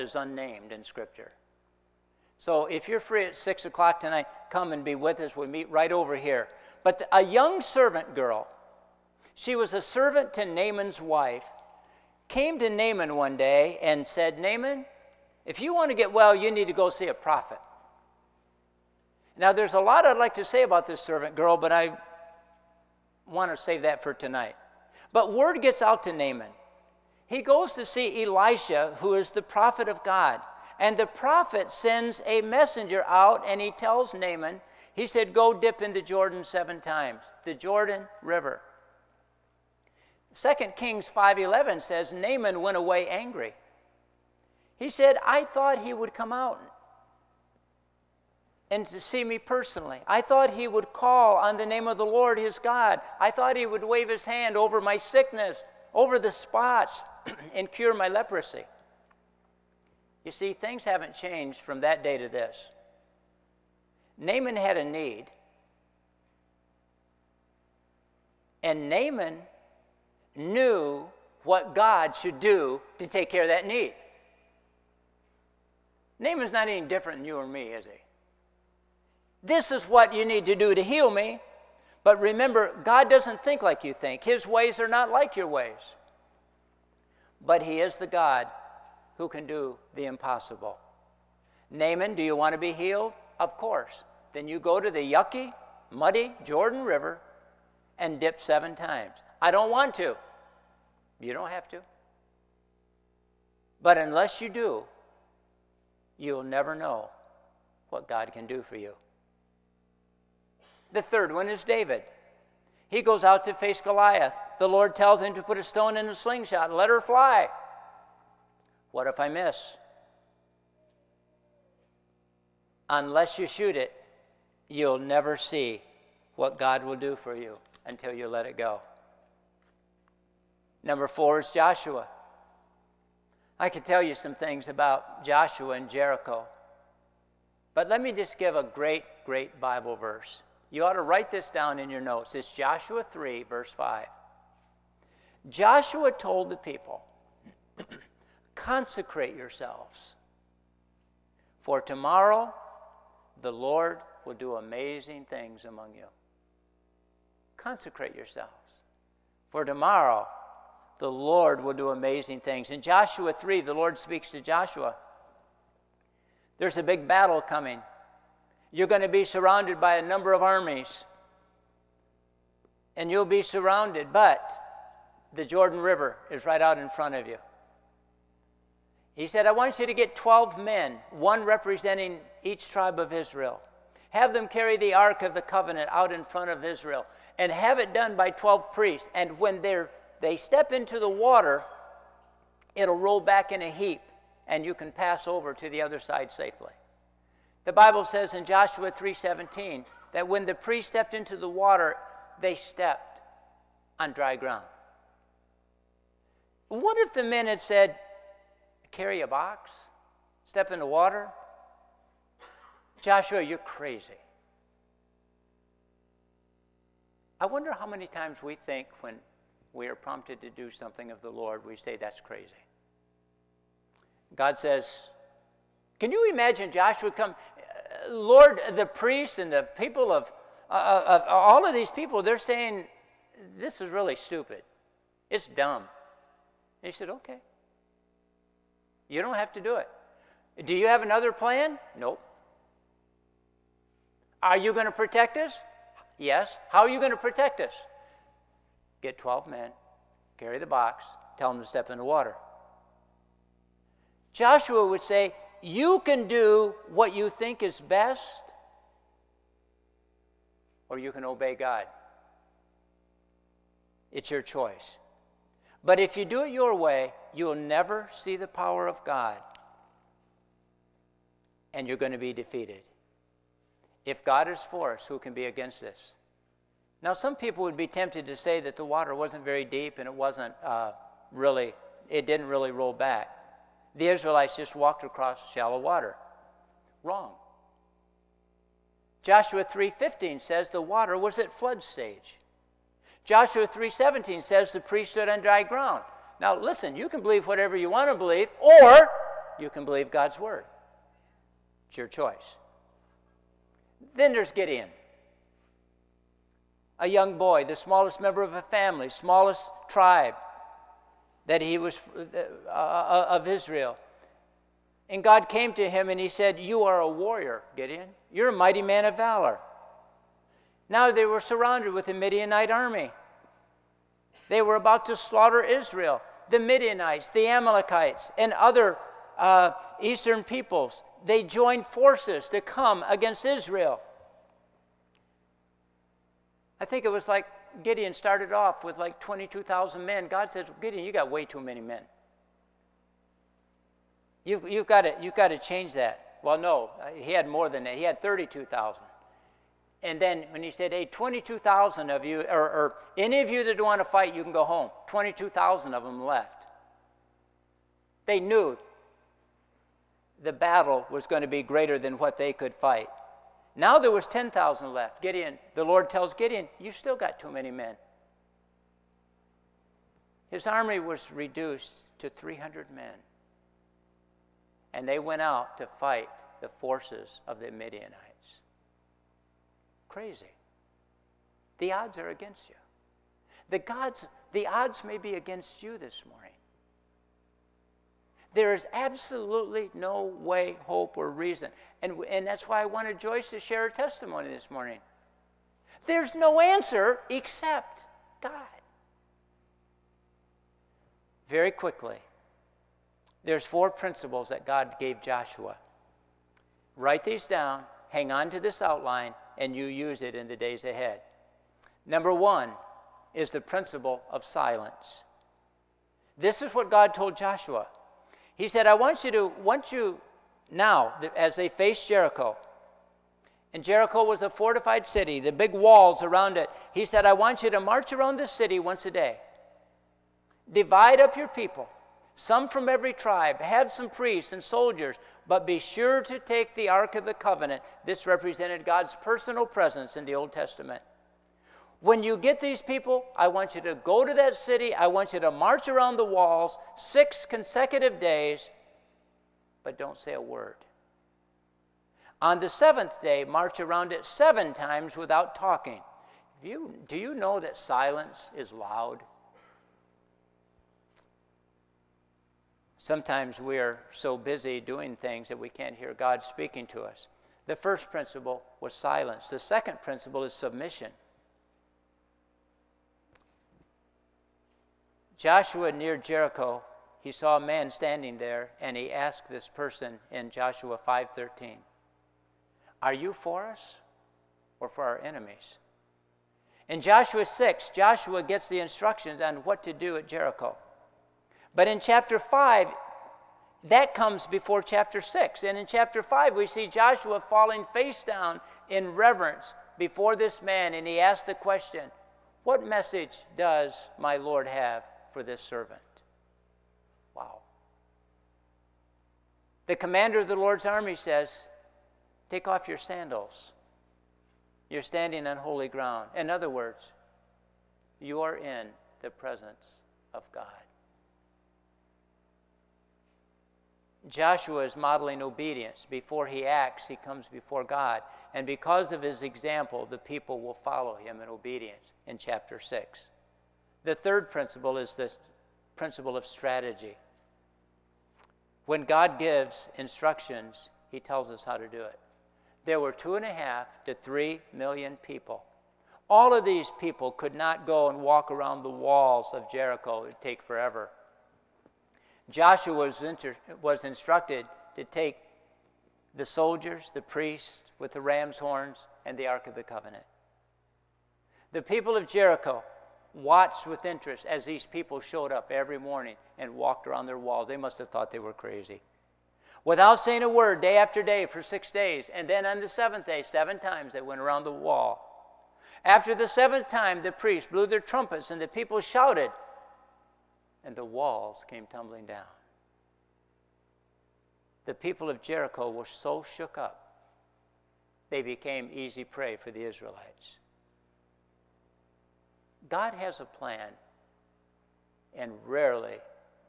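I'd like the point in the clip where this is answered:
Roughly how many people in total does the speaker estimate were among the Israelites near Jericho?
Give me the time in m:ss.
9:03.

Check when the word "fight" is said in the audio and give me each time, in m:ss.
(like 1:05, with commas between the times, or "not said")
5:54, 6:02, 6:15.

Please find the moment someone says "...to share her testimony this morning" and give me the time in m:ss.
6:33.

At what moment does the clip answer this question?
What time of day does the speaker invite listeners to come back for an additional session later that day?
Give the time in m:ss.
0:03.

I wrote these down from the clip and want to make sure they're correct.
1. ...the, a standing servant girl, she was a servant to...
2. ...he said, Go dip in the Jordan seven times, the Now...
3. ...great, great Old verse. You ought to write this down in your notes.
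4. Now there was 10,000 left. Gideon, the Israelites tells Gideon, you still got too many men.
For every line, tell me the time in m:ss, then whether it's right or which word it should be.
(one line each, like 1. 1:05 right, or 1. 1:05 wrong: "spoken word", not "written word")
1. 0:06 wrong: "young", not "standing"
2. 0:34 wrong: "Jordan", not "Now"
3. 2:18 wrong: "Bible", not "Old"
4. 6:03 wrong: "Lord", not "Israelites".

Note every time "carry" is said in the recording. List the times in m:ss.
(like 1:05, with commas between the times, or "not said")
3:04, 3:28, 4:10.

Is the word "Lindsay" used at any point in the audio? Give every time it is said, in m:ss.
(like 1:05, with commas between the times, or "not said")
not said.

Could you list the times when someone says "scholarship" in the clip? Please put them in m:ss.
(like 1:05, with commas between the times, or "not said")
not said.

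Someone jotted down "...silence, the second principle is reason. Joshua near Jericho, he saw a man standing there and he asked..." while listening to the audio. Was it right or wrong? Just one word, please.
wrong.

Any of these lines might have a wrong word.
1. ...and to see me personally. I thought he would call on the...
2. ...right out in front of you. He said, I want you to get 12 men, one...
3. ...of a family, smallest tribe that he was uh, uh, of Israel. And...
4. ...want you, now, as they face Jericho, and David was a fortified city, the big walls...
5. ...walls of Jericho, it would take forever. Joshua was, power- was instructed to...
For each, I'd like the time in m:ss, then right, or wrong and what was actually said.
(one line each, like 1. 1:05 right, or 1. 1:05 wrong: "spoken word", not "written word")
1. 0:48 right
2. 2:56 right
3. 5:08 right
4. 6:59 wrong: "Jericho", not "David"
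5. 9:08 wrong: "inter", not "power".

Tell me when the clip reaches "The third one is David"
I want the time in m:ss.
1:50.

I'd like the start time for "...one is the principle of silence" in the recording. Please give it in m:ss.
6:52.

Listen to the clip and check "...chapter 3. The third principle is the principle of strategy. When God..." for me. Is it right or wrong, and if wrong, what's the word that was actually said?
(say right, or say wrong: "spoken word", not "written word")
wrong: "6", not "3".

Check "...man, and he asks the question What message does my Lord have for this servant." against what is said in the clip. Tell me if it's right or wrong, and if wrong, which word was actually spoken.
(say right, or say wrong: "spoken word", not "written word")
right.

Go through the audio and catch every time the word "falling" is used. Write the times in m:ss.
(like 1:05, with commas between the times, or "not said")
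8:17.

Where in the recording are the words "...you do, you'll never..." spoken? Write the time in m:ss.
1:44.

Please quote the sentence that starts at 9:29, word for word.
Without saying a word, day after day, for six days.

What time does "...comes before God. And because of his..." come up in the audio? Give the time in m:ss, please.
8:47.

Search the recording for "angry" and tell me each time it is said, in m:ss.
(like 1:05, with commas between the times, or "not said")
0:43.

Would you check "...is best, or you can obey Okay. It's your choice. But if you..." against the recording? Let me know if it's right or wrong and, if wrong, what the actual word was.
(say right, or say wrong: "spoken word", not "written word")
wrong: "God", not "Okay".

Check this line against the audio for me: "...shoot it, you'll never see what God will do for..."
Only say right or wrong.
right.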